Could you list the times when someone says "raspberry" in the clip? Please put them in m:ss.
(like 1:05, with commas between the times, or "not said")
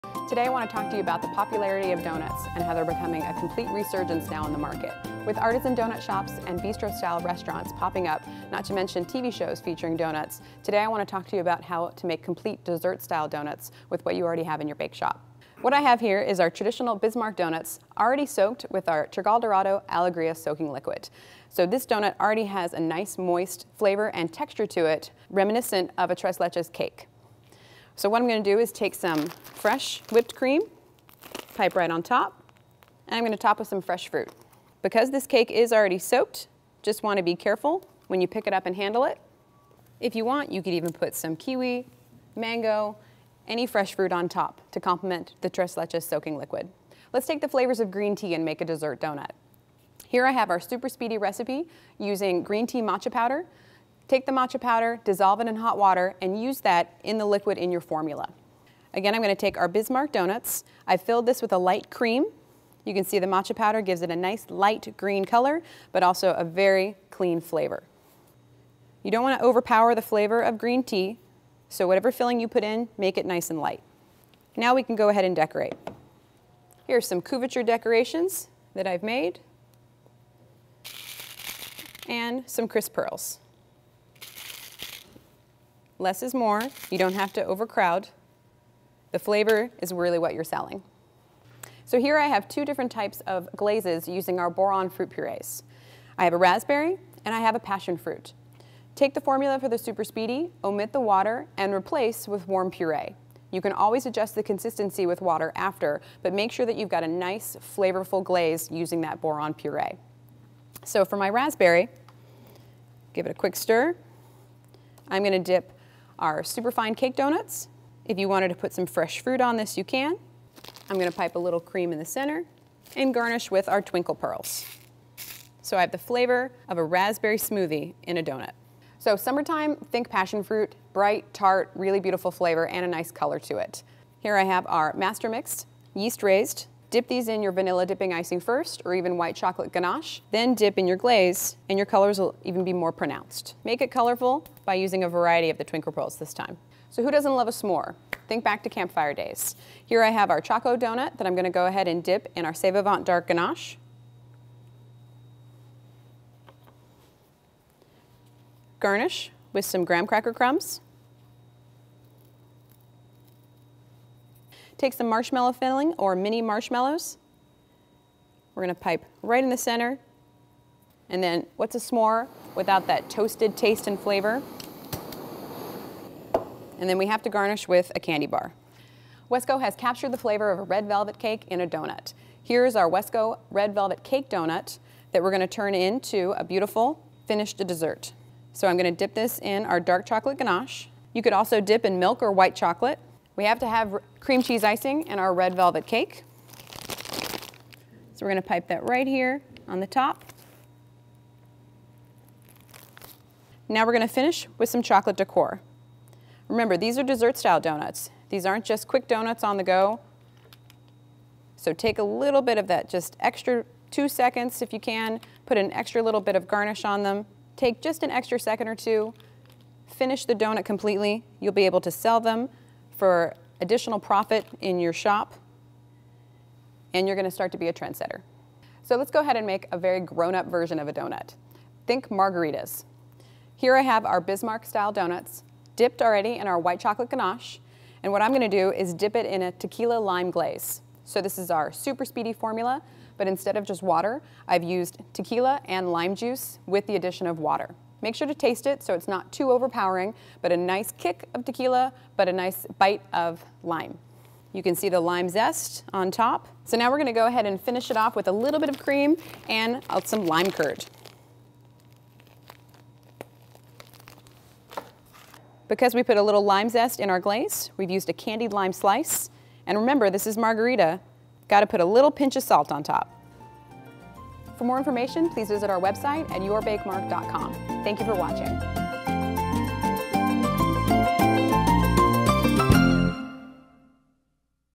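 1:36, 1:51, 2:06.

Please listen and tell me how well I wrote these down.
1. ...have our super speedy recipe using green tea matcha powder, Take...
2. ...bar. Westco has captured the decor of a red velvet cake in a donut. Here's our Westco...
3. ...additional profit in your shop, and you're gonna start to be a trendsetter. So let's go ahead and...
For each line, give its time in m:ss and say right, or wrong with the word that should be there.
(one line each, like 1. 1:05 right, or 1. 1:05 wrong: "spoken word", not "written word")
1. 0:50 right
2. 2:58 wrong: "flavor", not "decor"
3. 3:43 right.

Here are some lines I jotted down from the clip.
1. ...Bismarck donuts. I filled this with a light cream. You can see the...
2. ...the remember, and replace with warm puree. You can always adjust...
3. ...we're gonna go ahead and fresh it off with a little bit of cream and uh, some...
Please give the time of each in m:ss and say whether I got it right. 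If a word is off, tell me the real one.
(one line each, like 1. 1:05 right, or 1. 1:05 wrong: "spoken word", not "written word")
1. 0:59 right
2. 1:40 wrong: "water", not "remember"
3. 4:16 wrong: "finish", not "fresh".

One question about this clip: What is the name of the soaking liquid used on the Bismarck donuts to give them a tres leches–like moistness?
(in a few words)
Dorado Allegria.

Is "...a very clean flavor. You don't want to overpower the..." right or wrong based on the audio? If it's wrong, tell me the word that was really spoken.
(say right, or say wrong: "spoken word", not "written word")
right.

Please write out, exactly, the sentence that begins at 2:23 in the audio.
Make it colorful by using a variety of the Twinkle Pearls this time.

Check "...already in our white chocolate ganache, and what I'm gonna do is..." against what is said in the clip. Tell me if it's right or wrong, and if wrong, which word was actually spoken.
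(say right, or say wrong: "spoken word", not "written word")
right.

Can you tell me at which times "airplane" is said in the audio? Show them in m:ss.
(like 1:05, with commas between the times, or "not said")
not said.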